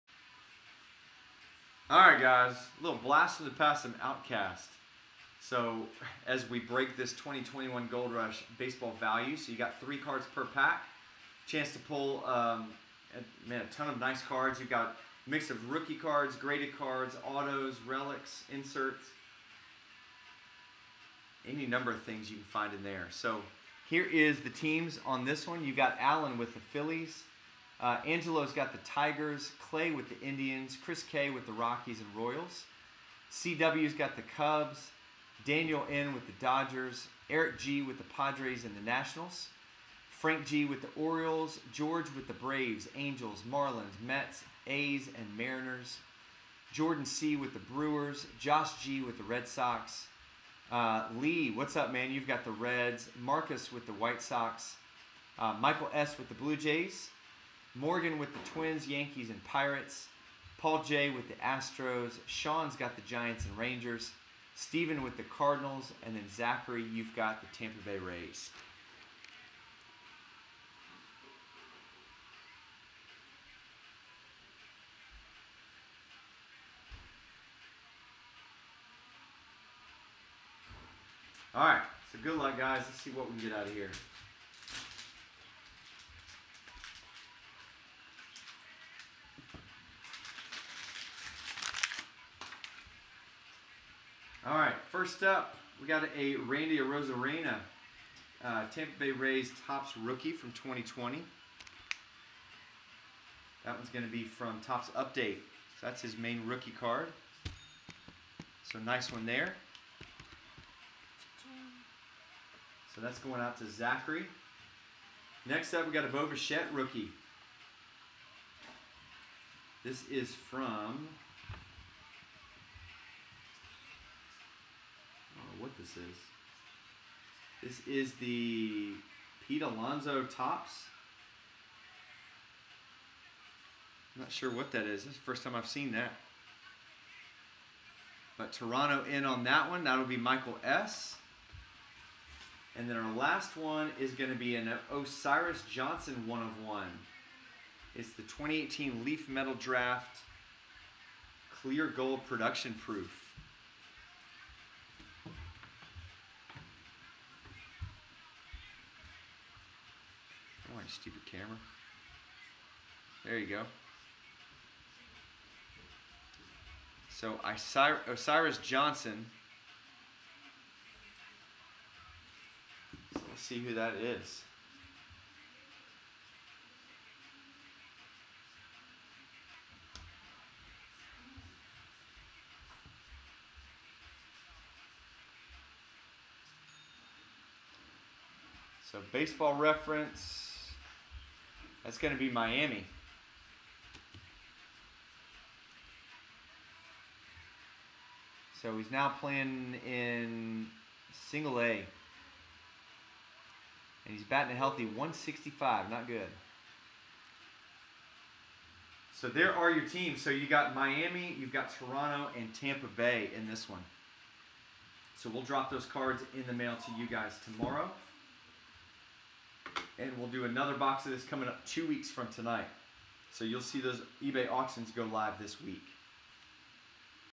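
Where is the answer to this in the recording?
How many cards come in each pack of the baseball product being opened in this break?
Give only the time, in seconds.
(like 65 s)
9 s.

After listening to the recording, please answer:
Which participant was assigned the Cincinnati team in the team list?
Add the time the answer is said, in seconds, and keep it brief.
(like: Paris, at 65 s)
Lee, at 51 s.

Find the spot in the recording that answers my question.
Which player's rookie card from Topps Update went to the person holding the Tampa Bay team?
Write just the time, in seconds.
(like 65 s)
96 s.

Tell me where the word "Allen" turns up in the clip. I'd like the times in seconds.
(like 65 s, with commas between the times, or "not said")
25 s.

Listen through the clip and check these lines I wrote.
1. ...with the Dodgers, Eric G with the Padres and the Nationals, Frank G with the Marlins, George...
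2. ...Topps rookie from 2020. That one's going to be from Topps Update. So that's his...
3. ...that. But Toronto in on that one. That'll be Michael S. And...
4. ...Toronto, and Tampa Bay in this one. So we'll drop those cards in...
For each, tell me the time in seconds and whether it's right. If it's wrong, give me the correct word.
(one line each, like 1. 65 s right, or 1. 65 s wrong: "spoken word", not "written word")
1. 36 s wrong: "Orioles", not "Marlins"
2. 99 s right
3. 135 s right
4. 211 s right.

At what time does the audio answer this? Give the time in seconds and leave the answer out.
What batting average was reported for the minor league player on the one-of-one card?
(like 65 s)
204 s.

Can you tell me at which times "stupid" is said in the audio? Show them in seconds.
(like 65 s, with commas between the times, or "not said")
160 s.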